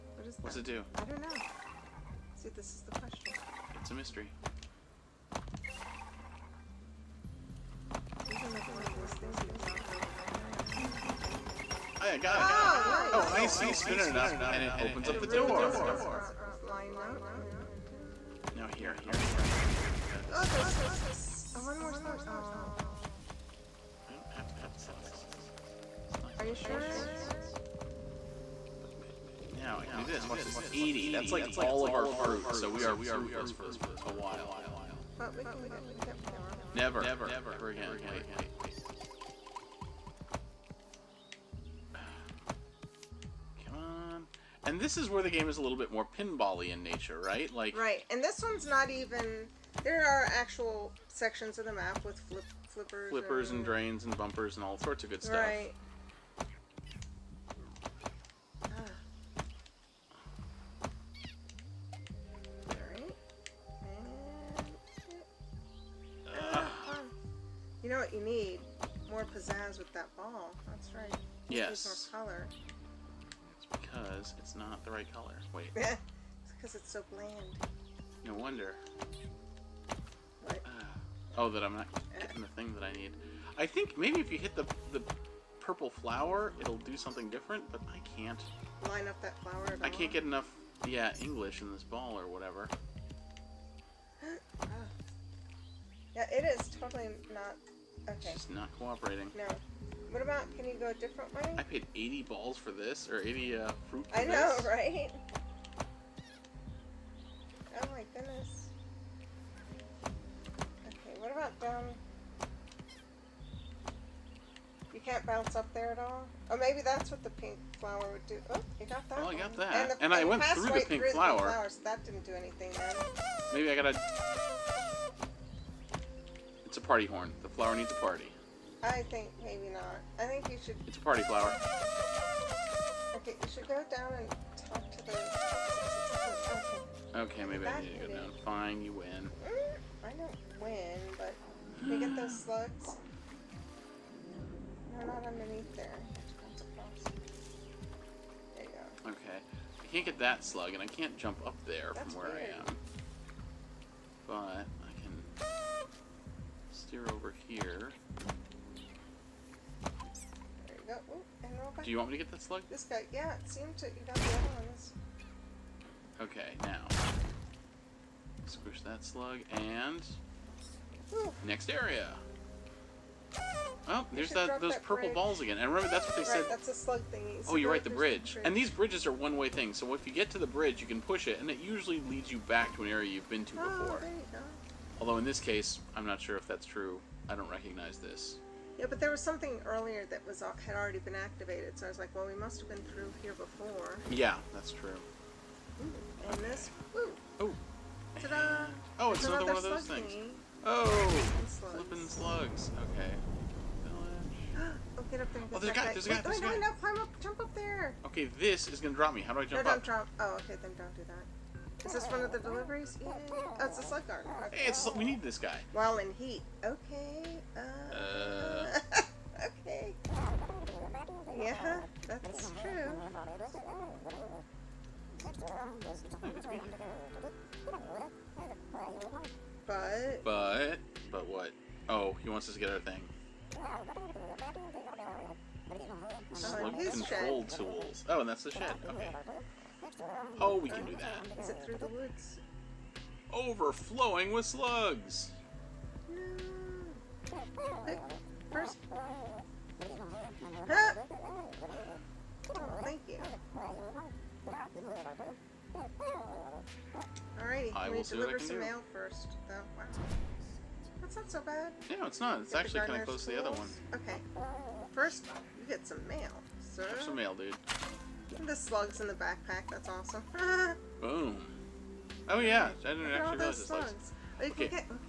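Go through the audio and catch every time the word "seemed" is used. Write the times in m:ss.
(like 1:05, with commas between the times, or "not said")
2:43.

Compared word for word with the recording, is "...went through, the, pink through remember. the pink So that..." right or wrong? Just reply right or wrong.
wrong.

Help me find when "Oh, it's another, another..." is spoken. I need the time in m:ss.
3:18.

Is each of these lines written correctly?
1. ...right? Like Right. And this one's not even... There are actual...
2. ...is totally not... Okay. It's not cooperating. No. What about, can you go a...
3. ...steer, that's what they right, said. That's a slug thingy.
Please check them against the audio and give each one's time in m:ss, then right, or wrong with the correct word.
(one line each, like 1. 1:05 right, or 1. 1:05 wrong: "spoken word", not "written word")
1. 0:47 right
2. 1:36 right
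3. 2:55 wrong: "remember", not "steer".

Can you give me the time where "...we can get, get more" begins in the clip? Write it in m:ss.
0:35.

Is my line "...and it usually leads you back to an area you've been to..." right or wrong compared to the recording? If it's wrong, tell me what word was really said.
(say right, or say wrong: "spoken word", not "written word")
right.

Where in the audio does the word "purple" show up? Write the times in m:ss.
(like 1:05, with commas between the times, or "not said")
1:25, 2:54.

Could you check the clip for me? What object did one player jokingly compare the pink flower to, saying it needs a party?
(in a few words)
A party horn.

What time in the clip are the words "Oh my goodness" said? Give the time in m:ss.
1:47.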